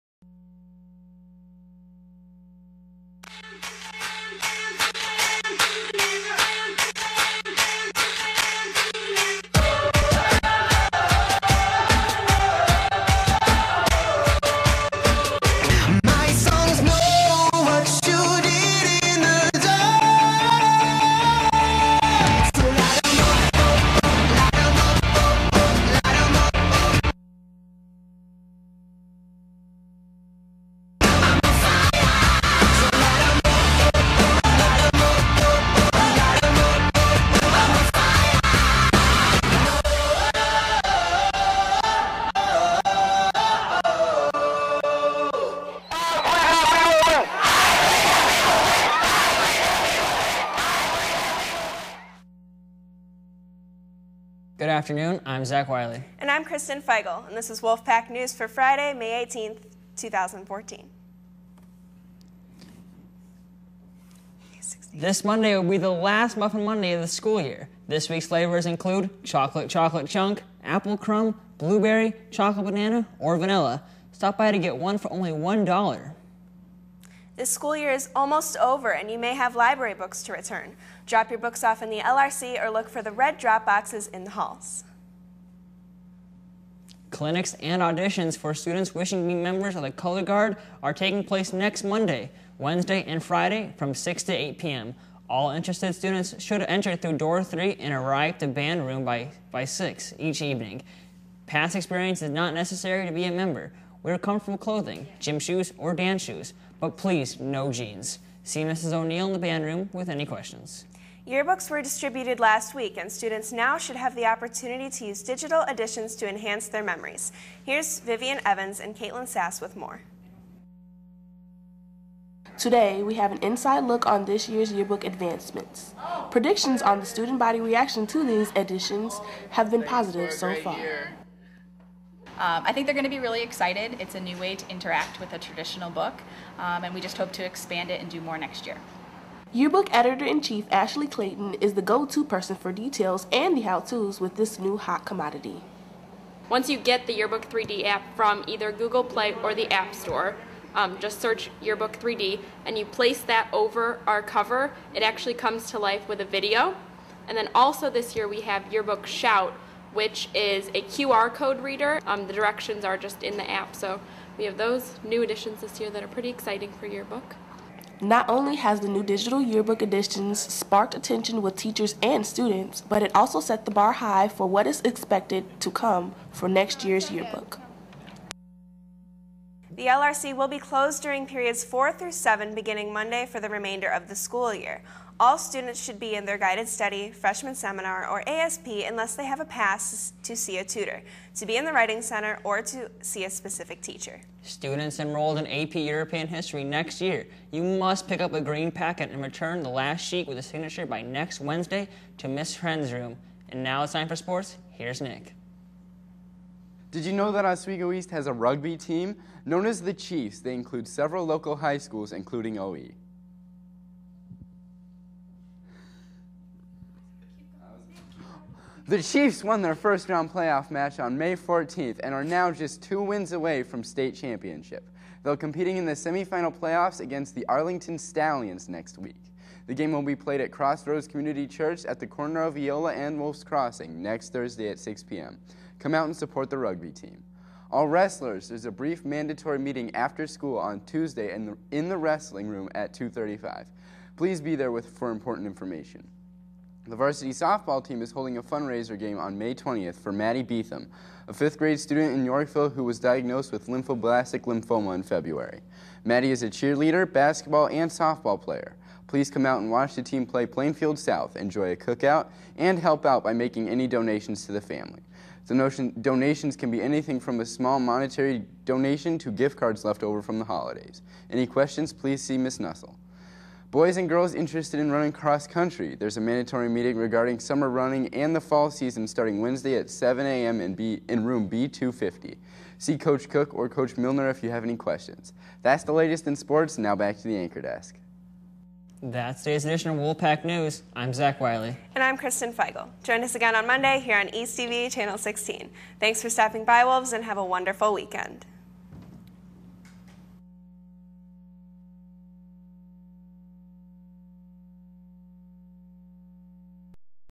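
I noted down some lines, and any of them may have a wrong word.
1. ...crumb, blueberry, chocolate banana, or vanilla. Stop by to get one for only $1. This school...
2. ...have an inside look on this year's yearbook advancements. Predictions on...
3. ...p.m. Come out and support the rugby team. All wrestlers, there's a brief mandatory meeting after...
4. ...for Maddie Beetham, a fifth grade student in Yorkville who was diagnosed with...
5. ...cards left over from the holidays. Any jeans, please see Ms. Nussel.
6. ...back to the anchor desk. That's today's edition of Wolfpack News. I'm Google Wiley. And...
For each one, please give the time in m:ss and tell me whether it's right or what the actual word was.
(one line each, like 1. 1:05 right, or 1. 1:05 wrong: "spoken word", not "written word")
1. 1:10 right
2. 2:03 right
3. 3:55 right
4. 4:09 right
5. 4:29 wrong: "questions", not "jeans"
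6. 4:46 wrong: "Zach", not "Google".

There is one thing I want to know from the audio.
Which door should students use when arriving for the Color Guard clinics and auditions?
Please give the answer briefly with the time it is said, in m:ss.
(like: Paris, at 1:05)
door 3, at 1:37.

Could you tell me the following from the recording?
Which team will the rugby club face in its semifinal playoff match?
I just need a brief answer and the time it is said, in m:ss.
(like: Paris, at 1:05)
Arlington Stallions, at 3:47.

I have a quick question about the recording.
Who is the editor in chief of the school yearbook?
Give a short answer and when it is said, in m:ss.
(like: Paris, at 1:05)
Ashley Clayton, at 2:20.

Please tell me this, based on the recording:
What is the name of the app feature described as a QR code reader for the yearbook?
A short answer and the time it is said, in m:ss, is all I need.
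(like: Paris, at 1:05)
Yearbook Shout, at 2:38.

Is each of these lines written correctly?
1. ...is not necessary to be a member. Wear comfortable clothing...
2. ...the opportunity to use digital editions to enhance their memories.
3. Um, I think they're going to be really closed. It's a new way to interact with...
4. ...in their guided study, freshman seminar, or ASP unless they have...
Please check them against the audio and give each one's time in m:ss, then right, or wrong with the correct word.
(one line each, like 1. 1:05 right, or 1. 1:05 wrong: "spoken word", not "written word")
1. 1:42 right
2. 1:54 right
3. 2:12 wrong: "excited", not "closed"
4. 3:06 right.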